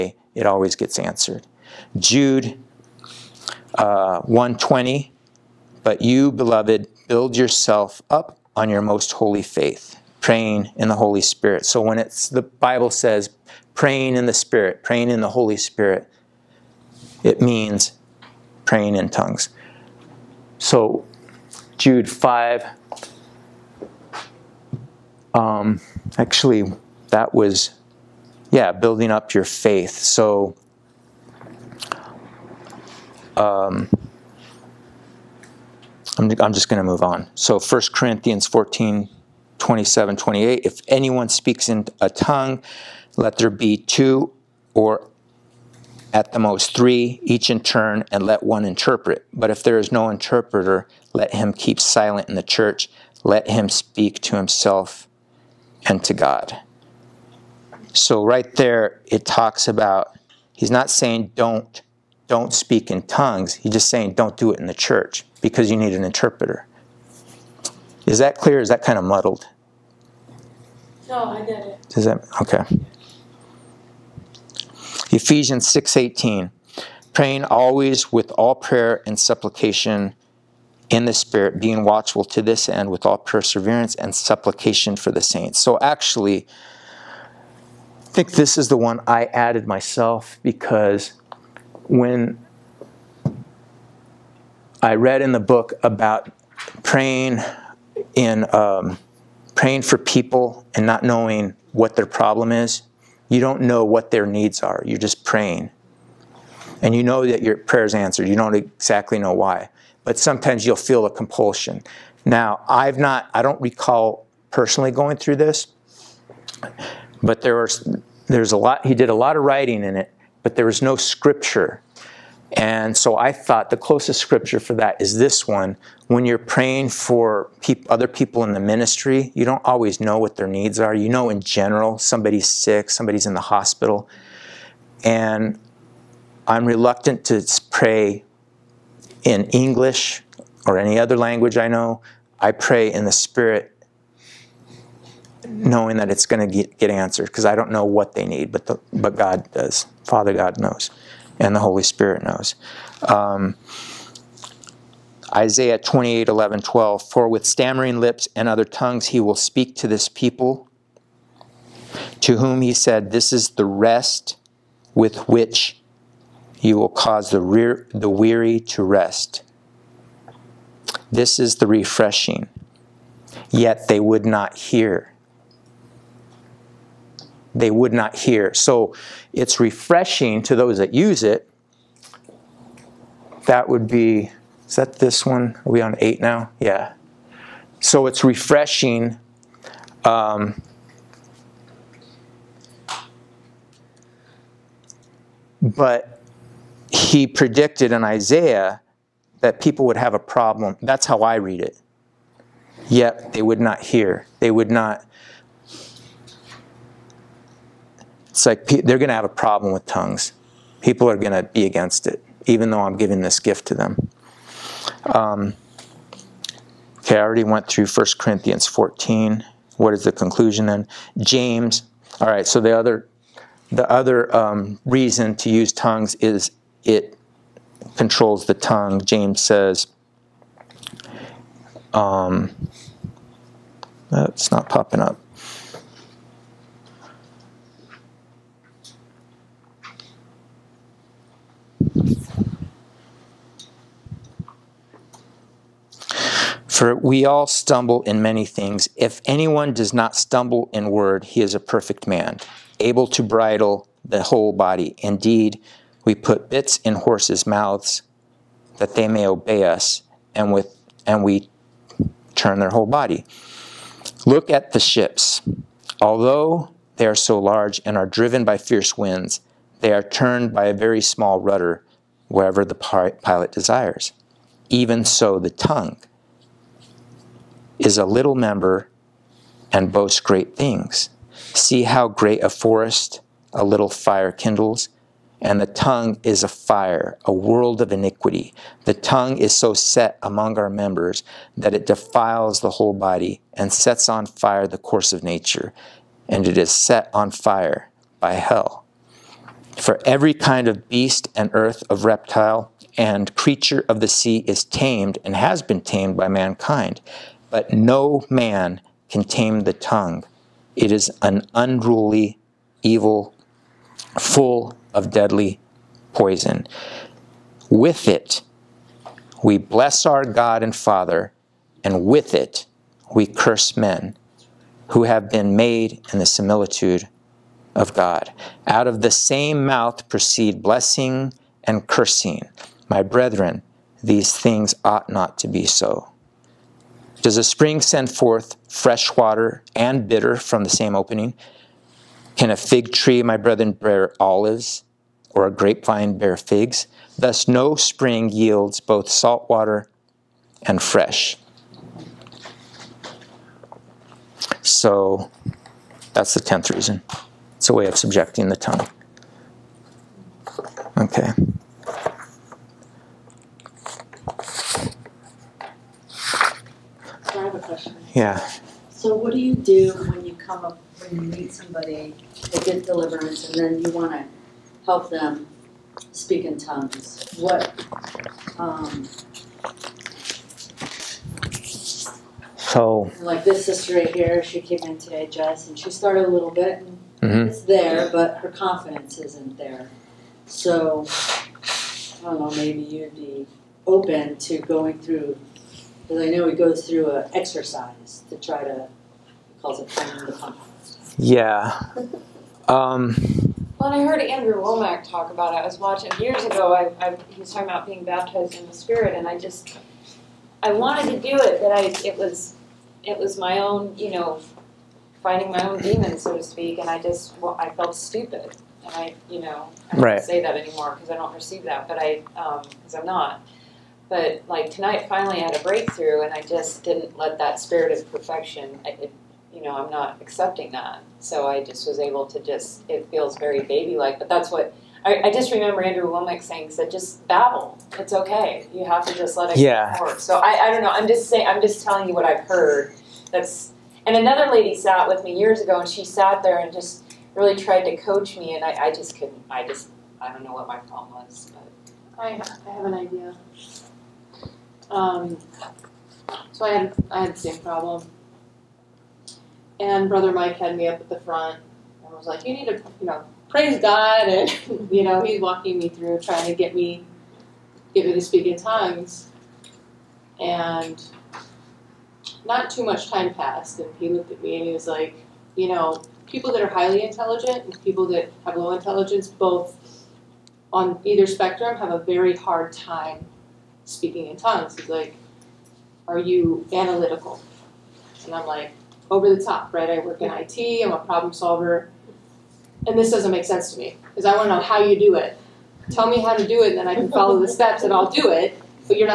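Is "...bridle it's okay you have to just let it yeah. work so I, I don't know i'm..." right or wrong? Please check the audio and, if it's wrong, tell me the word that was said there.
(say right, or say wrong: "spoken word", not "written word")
wrong: "babble", not "bridle".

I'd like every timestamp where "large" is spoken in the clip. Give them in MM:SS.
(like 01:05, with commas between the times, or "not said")
04:27.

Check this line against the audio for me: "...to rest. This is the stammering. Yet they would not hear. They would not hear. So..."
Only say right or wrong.
wrong.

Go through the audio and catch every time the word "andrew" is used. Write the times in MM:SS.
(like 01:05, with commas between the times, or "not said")
06:44, 07:15.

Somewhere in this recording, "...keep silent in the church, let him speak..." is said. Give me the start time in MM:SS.
00:51.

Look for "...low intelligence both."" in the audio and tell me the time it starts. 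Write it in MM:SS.
07:58.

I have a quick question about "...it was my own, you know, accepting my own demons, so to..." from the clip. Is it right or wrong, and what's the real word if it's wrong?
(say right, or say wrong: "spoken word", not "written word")
wrong: "finding", not "accepting".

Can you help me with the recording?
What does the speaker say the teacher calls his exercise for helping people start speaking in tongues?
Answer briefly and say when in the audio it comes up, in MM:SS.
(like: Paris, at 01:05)
finding the pump, at 06:39.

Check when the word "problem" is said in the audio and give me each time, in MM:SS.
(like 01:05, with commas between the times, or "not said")
01:42, 03:20, 03:29, 07:30, 07:37, 08:10.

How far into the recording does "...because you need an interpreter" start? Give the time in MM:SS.
01:05.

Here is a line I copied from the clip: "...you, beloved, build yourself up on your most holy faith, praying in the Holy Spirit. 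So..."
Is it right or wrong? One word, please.
right.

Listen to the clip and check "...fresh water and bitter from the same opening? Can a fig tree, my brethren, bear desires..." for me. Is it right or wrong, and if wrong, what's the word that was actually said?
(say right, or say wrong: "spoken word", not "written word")
wrong: "olives", not "desires".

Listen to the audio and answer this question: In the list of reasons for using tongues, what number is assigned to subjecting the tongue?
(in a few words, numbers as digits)
10th.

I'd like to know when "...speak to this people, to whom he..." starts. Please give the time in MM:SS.
02:39.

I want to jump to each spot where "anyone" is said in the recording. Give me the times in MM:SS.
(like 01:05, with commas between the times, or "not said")
00:40, 04:09.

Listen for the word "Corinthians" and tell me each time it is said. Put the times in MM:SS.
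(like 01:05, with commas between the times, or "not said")
00:37, 03:38.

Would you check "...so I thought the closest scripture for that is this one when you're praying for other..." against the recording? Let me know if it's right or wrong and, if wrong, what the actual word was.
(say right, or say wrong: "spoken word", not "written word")
right.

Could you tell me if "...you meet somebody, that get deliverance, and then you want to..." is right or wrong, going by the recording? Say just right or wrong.
right.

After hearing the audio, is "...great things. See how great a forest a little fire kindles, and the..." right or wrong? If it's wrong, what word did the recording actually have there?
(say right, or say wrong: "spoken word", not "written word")
right.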